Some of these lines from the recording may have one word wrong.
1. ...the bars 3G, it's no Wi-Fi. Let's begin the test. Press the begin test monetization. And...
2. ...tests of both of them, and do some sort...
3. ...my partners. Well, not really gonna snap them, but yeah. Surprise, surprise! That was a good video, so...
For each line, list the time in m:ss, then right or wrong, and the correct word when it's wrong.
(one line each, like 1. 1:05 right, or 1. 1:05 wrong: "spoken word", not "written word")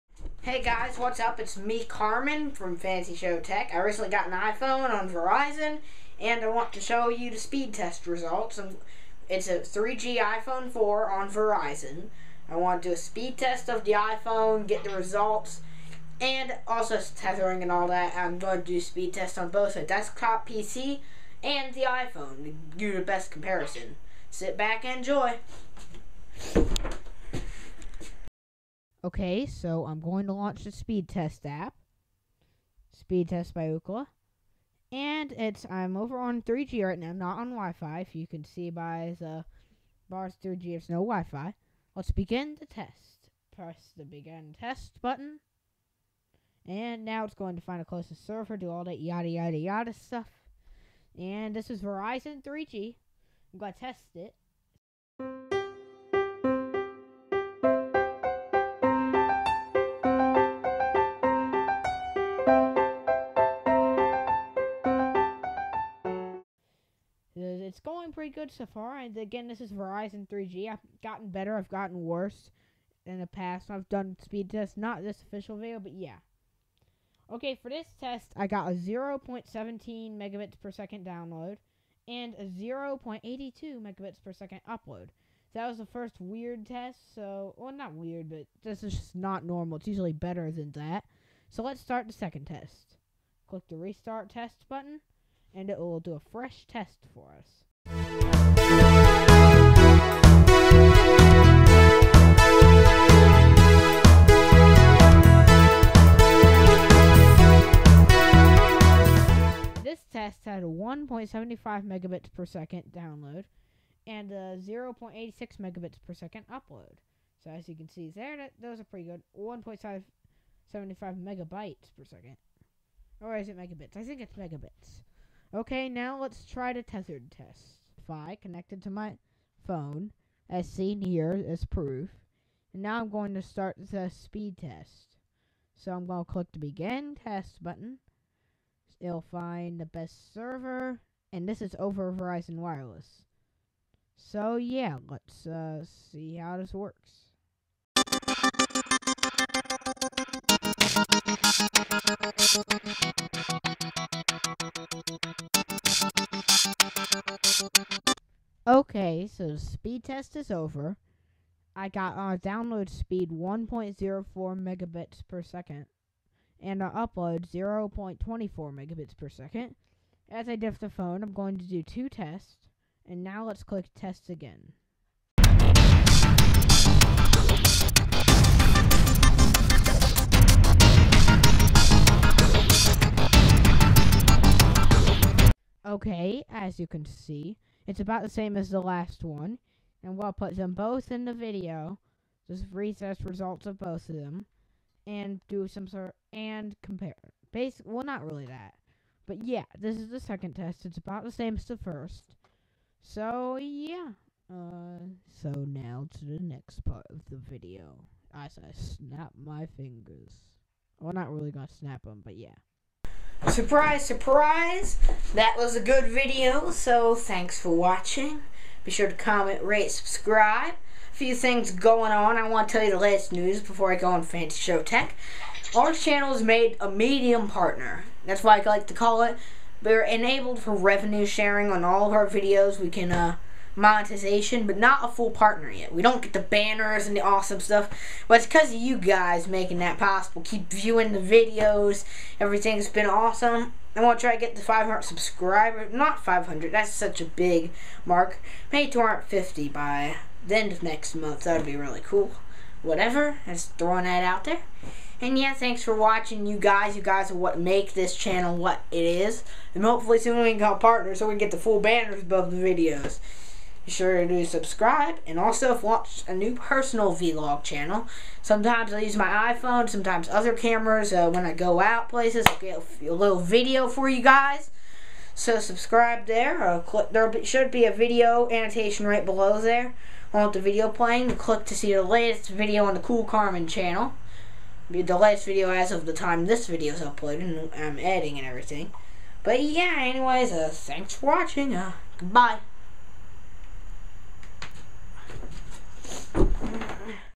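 1. 0:39 wrong: "button", not "monetization"
2. 3:13 wrong: "results", not "tests"
3. 3:29 wrong: "fingers", not "partners".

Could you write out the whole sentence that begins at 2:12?
And now I'm going to start the speed test.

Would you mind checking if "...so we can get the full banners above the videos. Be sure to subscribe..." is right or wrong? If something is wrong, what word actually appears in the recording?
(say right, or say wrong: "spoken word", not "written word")
right.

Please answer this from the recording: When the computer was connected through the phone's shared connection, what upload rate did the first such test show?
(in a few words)
0.24 megabits per second.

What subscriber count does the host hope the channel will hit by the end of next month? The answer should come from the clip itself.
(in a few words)
250.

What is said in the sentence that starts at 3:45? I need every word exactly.
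Our Channel is made a medium partner.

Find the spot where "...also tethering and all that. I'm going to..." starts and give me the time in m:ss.
0:16.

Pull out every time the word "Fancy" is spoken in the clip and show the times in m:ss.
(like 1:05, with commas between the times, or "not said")
0:02, 3:44.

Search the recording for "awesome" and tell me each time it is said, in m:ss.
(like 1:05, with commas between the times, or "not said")
3:57, 4:03.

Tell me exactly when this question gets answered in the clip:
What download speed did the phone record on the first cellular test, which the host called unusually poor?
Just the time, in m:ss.
1:18.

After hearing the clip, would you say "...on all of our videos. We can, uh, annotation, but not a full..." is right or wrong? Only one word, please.
wrong.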